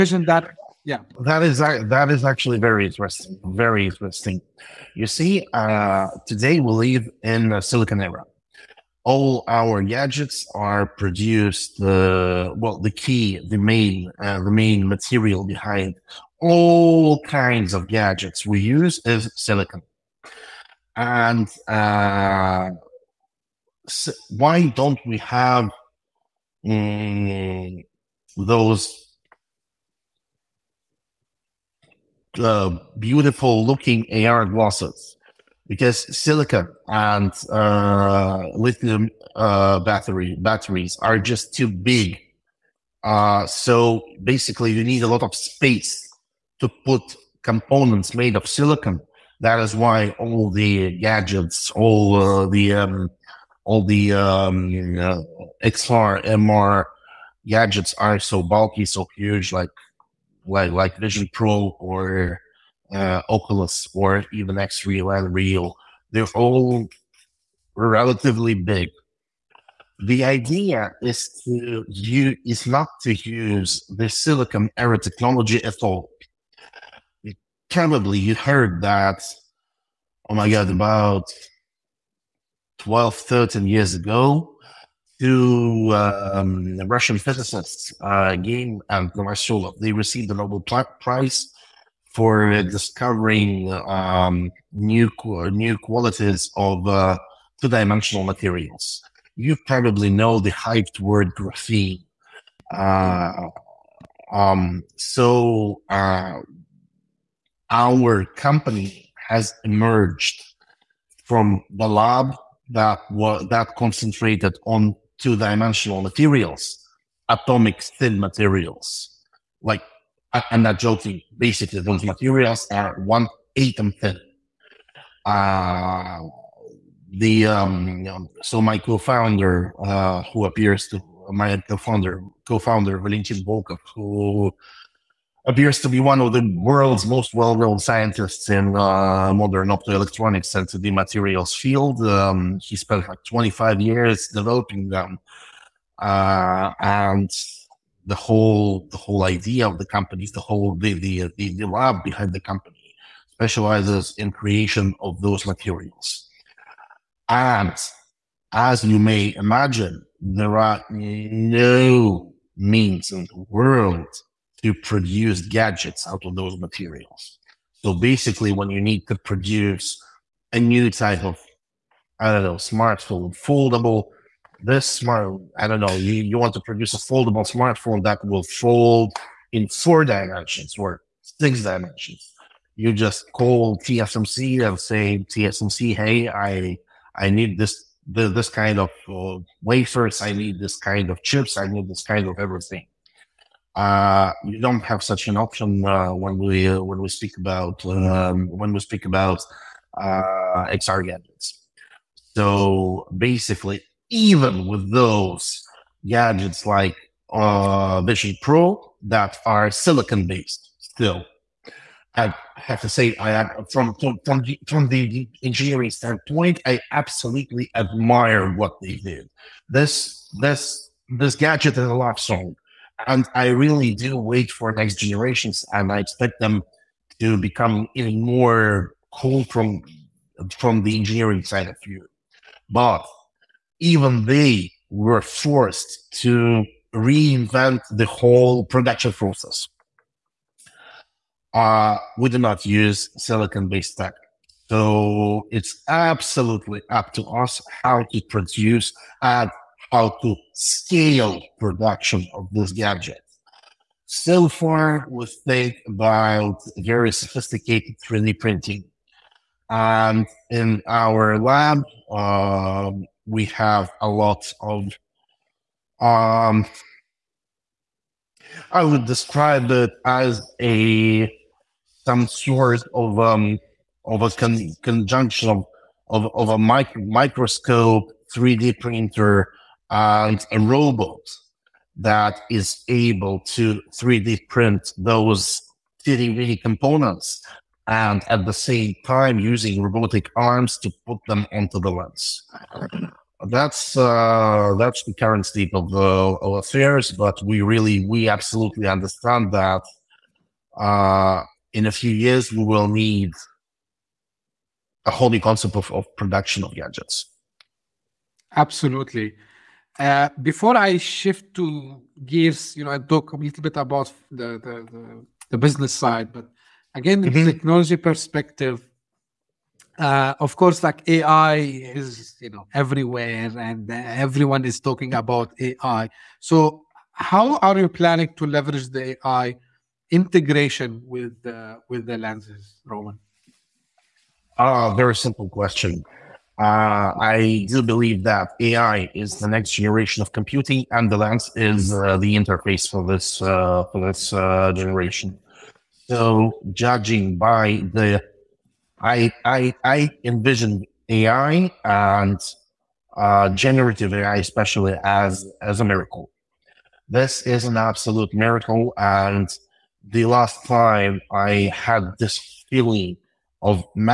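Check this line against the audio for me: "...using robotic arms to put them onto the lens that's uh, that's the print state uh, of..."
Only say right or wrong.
wrong.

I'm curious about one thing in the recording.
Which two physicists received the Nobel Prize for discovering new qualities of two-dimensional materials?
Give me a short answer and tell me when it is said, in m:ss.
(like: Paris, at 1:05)
Geim and Novoselov, at 1:28.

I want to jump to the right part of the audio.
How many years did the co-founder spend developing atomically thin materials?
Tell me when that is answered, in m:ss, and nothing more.
2:23.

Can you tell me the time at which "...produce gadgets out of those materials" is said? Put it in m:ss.
2:44.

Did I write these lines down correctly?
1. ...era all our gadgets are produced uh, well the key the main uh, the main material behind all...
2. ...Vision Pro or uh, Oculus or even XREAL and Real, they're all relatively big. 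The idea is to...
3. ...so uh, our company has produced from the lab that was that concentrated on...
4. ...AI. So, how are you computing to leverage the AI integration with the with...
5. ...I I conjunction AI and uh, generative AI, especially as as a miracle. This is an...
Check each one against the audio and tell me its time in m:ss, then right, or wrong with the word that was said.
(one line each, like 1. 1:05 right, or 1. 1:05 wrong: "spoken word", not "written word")
1. 0:08 right
2. 1:00 right
3. 1:44 wrong: "emerged", not "produced"
4. 5:25 wrong: "planning", not "computing"
5. 5:49 wrong: "envision", not "conjunction".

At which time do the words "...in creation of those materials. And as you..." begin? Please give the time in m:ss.
2:34.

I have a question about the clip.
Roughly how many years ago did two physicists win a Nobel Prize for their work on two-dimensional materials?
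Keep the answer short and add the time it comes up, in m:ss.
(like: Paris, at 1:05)
12-13 years, at 1:22.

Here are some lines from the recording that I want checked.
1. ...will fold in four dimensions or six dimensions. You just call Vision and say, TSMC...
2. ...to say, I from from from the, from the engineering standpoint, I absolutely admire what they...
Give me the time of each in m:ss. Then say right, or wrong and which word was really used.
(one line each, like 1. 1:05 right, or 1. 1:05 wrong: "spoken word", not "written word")
1. 2:58 wrong: "TSMC", not "Vision"
2. 3:32 right.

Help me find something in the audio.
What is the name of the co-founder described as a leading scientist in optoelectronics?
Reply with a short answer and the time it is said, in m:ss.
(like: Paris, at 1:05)
Valentyn Volkov, at 2:12.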